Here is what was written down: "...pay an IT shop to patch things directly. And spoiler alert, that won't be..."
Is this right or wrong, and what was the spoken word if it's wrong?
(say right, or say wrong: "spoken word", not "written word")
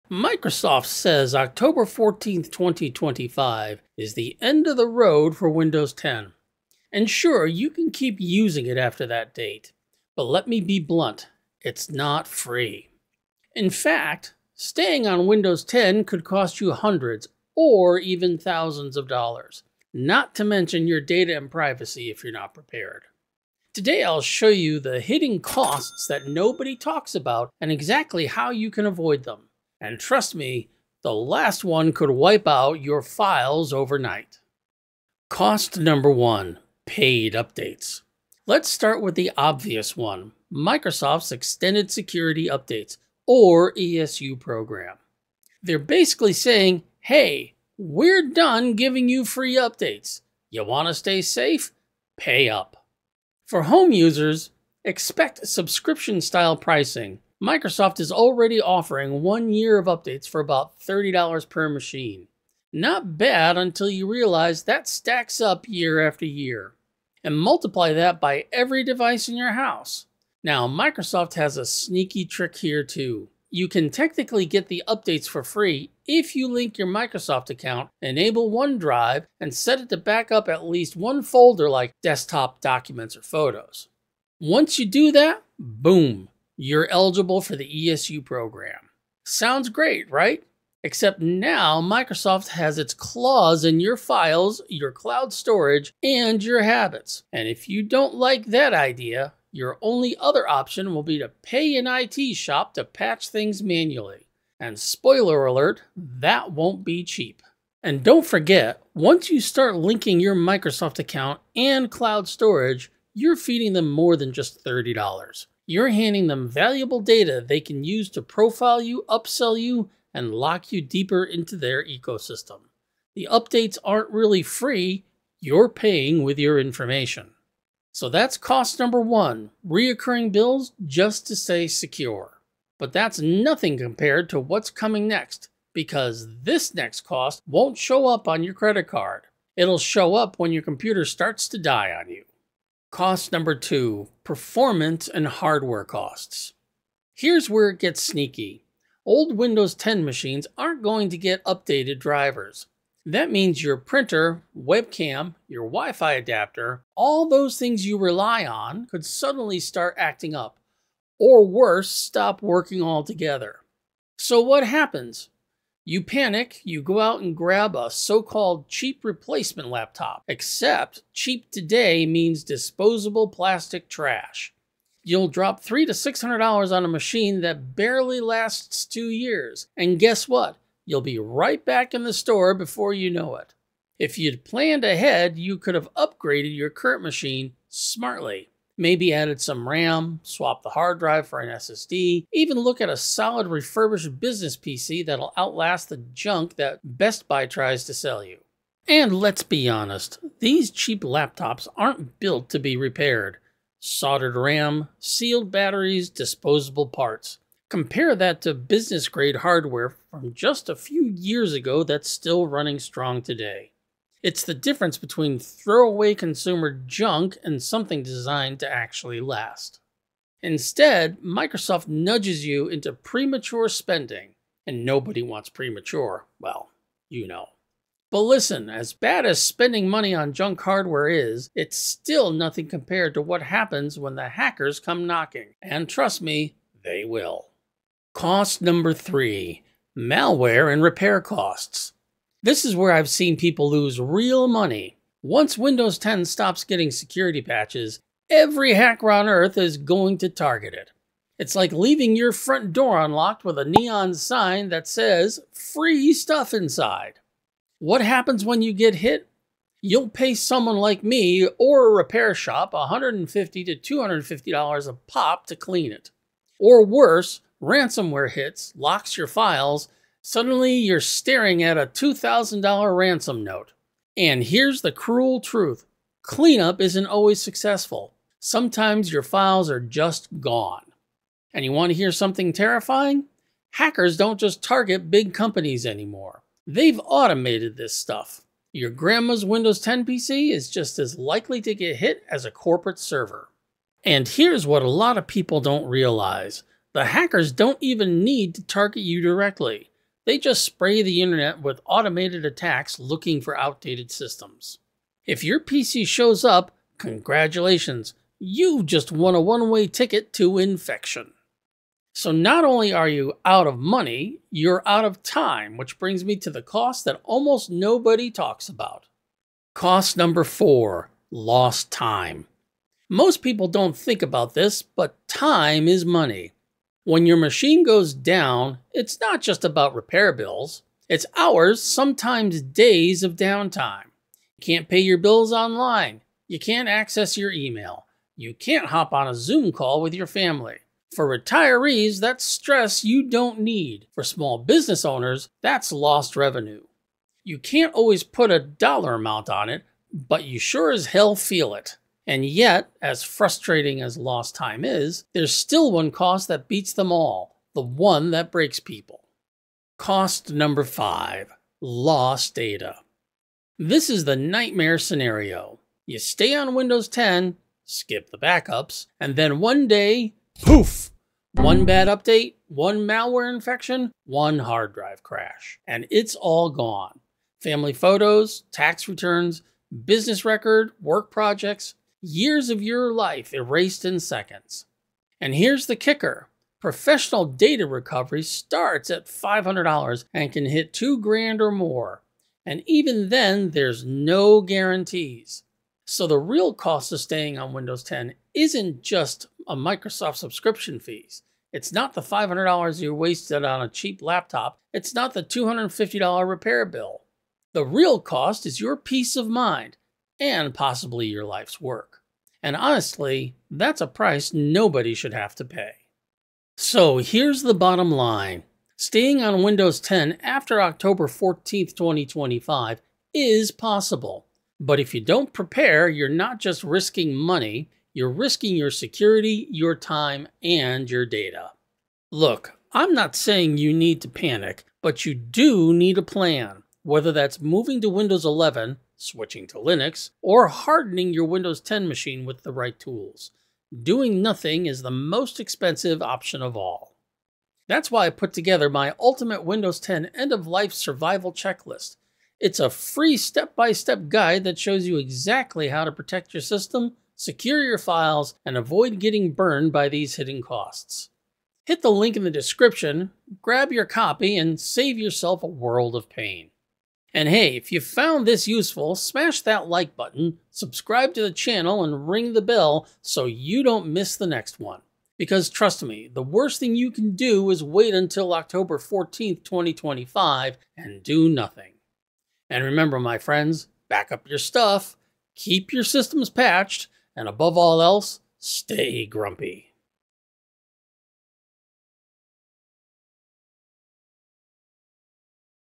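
wrong: "manually", not "directly".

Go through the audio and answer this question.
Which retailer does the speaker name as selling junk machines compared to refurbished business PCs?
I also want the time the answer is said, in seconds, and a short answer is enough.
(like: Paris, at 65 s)
Best Buy, at 196 s.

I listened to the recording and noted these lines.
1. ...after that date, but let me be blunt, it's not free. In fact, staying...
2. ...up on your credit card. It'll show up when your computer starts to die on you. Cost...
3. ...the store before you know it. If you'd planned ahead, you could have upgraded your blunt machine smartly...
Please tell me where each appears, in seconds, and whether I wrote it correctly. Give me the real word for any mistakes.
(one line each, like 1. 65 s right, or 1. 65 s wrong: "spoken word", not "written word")
1. 8 s right
2. 138 s right
3. 182 s wrong: "current", not "blunt".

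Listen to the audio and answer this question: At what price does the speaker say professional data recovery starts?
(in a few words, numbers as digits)
$500.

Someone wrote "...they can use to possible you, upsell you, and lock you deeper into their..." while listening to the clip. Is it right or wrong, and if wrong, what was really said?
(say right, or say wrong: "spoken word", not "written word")
wrong: "profile", not "possible".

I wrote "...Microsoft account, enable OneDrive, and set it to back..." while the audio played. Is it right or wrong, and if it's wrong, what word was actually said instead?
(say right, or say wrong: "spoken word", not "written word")
right.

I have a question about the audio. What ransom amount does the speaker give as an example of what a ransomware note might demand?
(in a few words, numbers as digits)
$2,000.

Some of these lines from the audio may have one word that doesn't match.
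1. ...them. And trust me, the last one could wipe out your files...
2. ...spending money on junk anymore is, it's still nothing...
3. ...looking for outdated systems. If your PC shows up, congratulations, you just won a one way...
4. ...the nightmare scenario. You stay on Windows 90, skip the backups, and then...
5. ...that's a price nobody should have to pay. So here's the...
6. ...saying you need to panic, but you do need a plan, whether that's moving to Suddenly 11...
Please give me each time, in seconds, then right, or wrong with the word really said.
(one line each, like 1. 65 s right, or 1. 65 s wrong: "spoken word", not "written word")
1. 29 s right
2. 229 s wrong: "hardware", not "anymore"
3. 302 s right
4. 364 s wrong: "10", not "90"
5. 413 s right
6. 433 s wrong: "Windows", not "Suddenly".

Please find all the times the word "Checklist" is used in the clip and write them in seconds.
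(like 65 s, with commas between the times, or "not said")
451 s.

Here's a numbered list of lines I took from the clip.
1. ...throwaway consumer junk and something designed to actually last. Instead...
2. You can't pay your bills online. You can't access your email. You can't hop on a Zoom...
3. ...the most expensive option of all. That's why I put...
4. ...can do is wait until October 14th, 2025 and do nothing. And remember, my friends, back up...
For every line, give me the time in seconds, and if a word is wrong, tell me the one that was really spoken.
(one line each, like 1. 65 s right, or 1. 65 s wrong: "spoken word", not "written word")
1. 215 s right
2. 334 s right
3. 445 s right
4. 477 s right.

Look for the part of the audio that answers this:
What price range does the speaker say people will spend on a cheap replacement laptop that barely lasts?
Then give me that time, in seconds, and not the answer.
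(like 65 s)
175 s.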